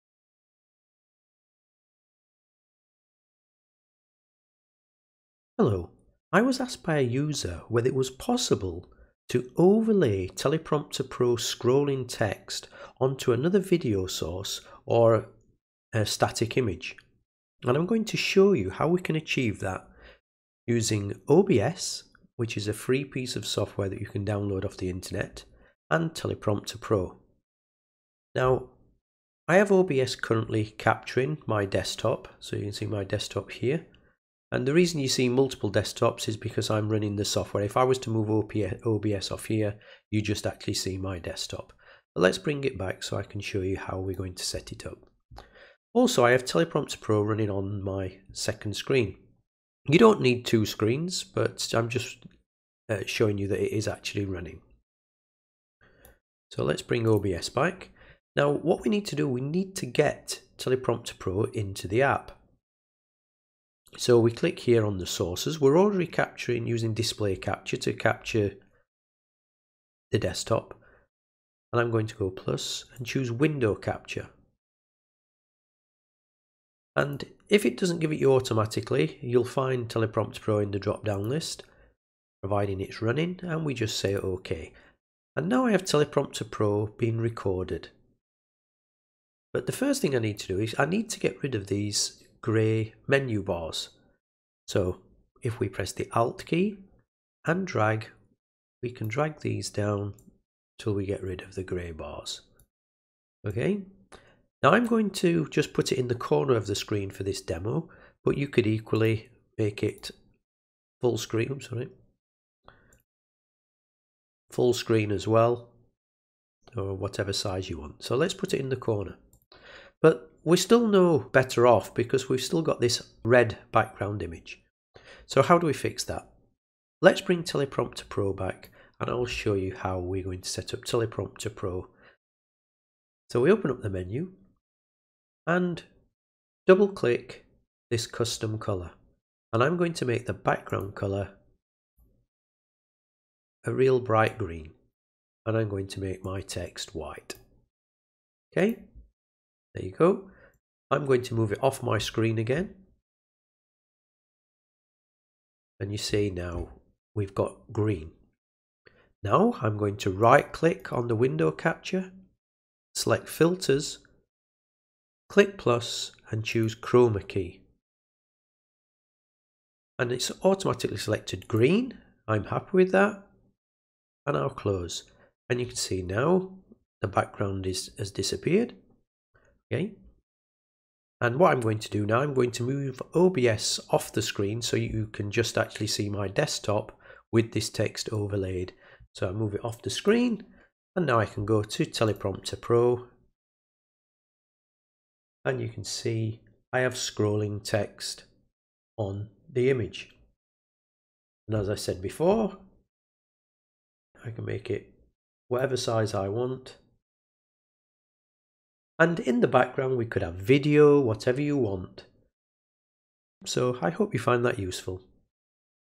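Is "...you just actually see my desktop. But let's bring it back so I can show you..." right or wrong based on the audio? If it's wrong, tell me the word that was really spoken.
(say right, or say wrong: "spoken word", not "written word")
right.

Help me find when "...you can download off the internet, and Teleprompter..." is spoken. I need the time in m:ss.
0:24.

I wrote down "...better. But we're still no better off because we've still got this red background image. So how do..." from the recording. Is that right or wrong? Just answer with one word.
wrong.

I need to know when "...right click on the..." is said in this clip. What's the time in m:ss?
2:40.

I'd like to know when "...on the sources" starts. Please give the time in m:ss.
1:04.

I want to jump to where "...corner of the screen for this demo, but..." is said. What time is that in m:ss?
1:46.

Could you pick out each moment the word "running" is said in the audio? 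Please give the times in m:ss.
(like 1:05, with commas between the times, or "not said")
0:36, 0:47, 0:54, 1:23.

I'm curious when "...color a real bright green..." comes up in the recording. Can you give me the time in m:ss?
2:20.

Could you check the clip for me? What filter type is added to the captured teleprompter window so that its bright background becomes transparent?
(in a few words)
Chroma key.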